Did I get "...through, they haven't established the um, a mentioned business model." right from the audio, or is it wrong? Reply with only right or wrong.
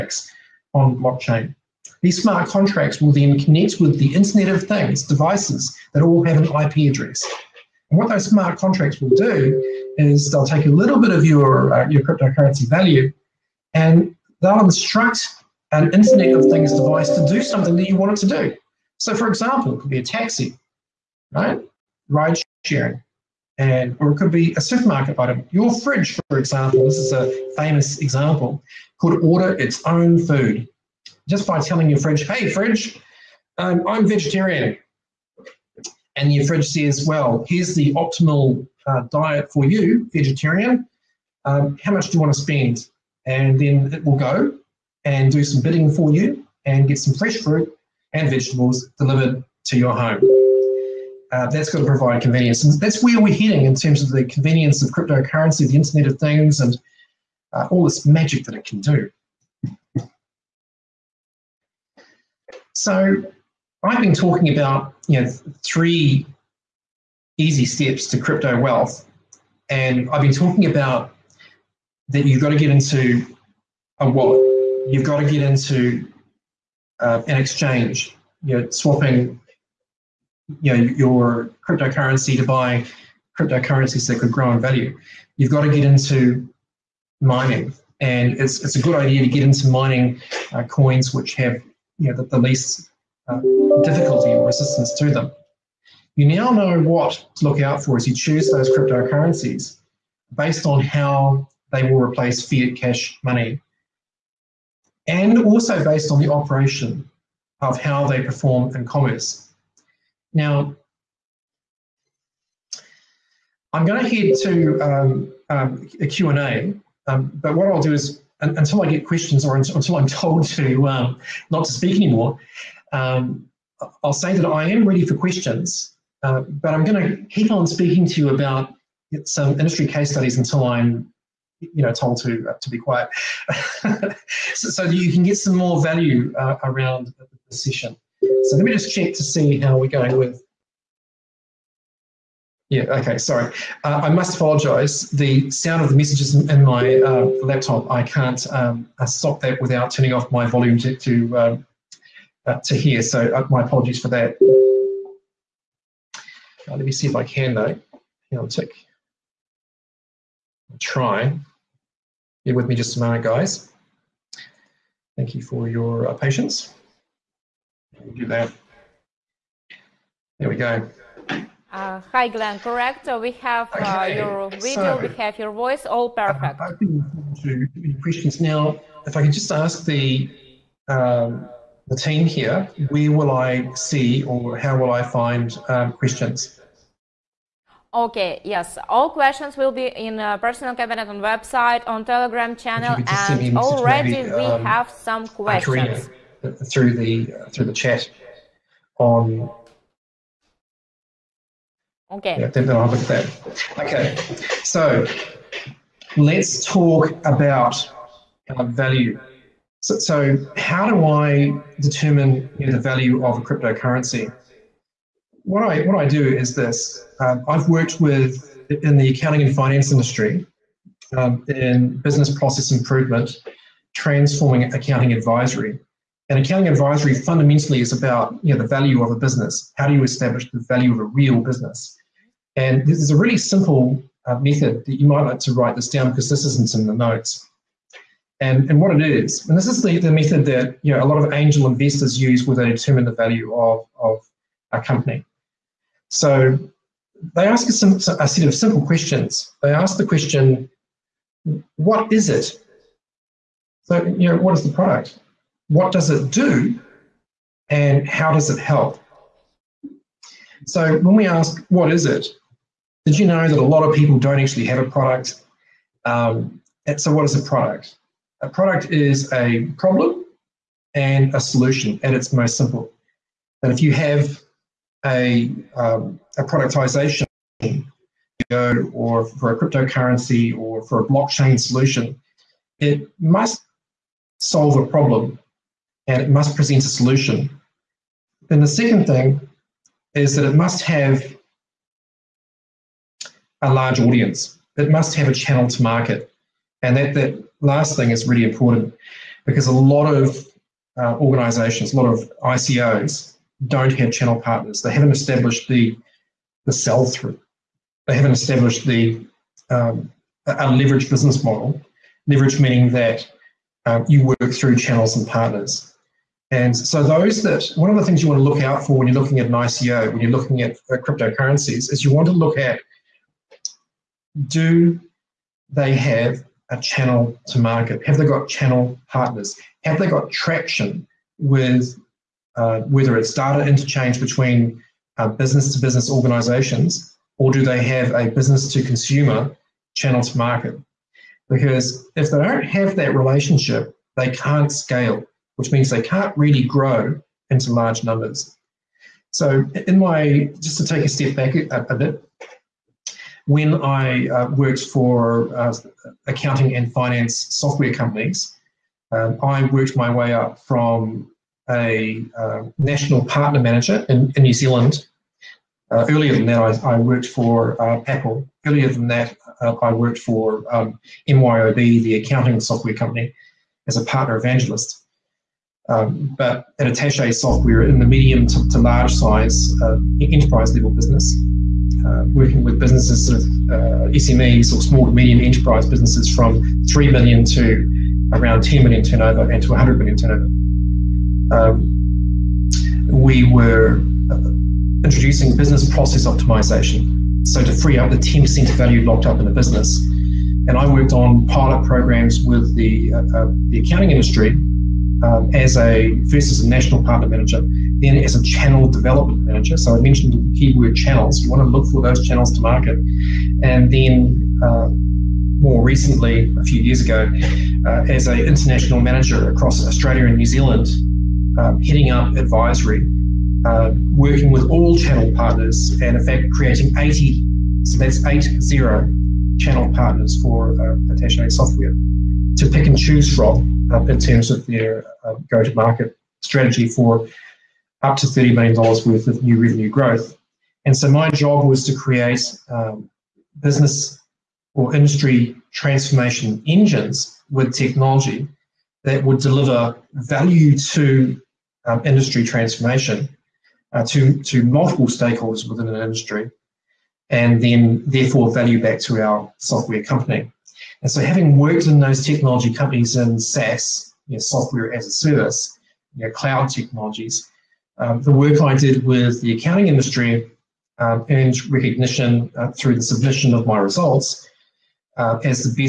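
wrong.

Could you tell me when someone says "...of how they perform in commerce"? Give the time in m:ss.
1:47.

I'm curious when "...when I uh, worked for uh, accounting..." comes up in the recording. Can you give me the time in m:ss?
5:53.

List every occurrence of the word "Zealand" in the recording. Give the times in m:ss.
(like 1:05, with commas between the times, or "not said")
6:04, 7:00.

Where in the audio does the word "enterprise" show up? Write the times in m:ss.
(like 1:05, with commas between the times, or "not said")
6:20, 6:25.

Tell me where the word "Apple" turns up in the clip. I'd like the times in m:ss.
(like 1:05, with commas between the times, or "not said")
6:08.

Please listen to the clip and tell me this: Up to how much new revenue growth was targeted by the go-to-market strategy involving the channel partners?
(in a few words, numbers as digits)
$30 million.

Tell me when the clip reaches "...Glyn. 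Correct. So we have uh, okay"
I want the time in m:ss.
2:52.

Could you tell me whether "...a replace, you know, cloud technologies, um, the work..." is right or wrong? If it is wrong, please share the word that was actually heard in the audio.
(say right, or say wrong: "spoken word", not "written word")
wrong: "service", not "replace".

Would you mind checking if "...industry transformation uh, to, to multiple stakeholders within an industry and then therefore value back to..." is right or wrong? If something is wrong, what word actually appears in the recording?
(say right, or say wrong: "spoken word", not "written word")
right.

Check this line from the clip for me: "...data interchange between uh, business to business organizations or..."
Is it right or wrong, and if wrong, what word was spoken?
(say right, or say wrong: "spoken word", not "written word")
right.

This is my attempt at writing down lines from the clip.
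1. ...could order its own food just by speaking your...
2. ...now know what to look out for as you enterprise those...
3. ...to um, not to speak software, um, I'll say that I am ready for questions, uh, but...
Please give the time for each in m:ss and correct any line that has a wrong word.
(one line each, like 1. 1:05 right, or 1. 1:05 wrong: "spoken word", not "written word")
1. 0:28 wrong: "telling", not "speaking"
2. 1:36 wrong: "choose", not "enterprise"
3. 2:00 wrong: "anymore", not "software".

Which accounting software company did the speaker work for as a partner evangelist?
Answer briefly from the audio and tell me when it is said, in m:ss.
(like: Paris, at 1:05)
MYOB, at 6:11.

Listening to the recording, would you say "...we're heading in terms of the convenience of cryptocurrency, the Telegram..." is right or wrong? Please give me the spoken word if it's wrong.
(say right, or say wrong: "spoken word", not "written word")
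wrong: "Internet", not "Telegram".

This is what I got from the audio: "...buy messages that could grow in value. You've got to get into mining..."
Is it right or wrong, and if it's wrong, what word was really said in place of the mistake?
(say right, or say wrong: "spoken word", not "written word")
wrong: "cryptocurrencies", not "messages".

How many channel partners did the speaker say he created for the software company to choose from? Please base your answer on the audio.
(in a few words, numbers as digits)
80.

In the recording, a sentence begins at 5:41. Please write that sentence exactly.
Because if they don't have that relationship, they can't scale which means they can't really grow into large numbers.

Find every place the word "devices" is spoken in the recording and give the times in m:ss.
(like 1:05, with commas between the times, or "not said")
0:05, 0:16.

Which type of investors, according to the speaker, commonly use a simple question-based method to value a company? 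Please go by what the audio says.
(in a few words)
angel investors.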